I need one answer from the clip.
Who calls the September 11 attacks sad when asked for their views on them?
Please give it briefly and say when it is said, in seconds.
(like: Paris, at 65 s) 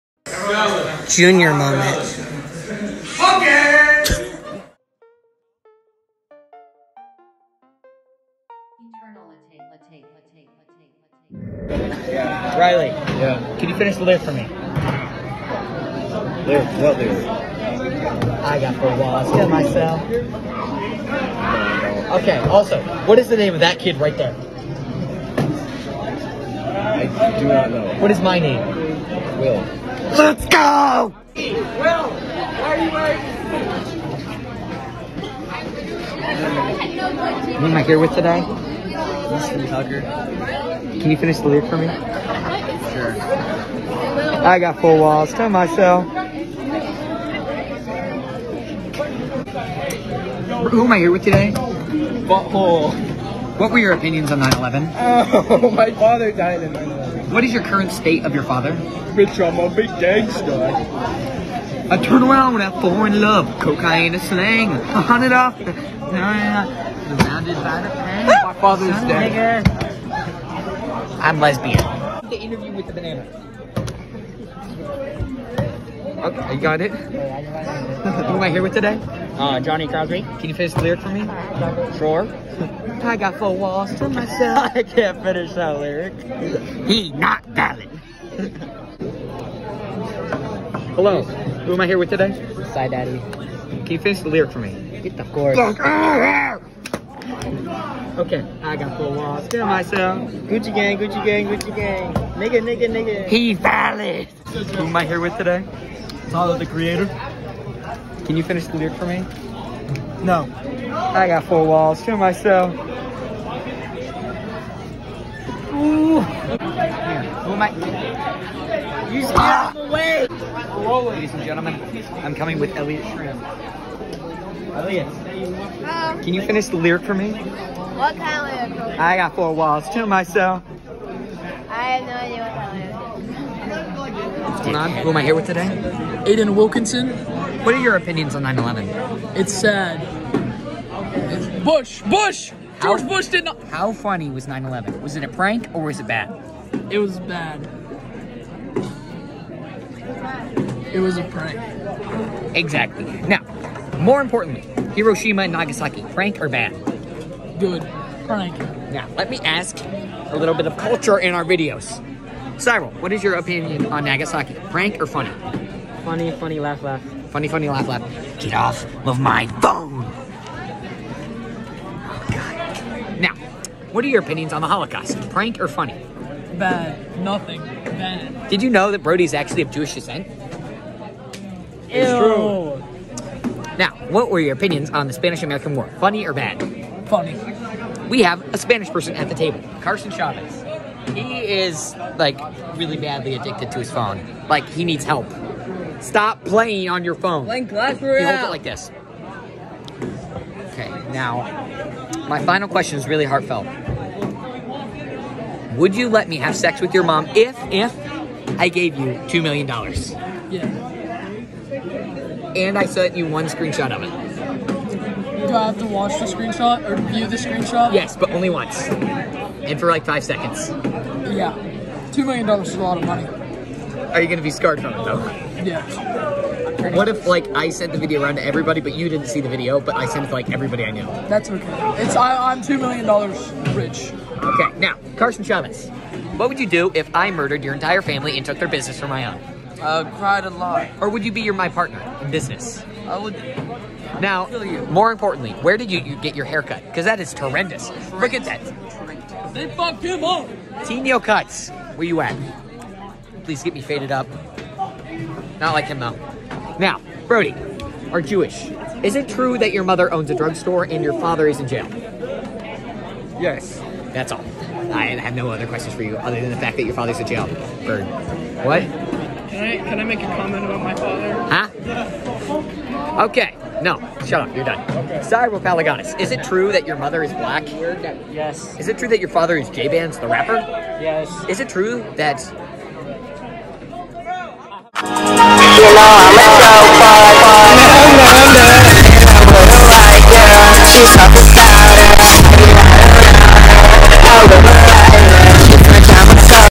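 Aiden Wilkinson, at 136 s.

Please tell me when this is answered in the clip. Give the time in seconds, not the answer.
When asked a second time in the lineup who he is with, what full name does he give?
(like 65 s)
38 s.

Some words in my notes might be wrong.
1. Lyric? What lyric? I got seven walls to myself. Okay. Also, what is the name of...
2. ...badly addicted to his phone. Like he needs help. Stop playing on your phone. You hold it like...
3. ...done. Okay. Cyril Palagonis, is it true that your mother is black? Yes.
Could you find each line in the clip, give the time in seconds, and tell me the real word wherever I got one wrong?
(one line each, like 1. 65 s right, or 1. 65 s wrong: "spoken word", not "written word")
1. 16 s wrong: "four", not "seven"
2. 192 s right
3. 274 s right.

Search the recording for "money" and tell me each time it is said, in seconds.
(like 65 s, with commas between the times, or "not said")
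223 s.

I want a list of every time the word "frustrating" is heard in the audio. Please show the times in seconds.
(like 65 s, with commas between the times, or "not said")
not said.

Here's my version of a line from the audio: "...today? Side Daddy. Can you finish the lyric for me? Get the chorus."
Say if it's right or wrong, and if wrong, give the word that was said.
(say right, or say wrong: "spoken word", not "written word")
right.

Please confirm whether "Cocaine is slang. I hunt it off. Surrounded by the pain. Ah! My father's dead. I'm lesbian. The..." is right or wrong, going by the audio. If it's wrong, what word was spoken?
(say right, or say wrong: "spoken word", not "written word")
right.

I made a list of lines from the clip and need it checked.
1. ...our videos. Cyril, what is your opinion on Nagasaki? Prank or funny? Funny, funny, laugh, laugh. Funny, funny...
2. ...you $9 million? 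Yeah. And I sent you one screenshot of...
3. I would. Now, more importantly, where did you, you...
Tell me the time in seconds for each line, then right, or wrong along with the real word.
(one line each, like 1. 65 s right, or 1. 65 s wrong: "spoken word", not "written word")
1. 161 s right
2. 208 s wrong: "2", not "9"
3. 243 s right.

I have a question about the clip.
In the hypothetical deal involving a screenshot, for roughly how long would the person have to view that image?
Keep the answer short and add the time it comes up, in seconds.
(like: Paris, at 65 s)
5 seconds, at 220 s.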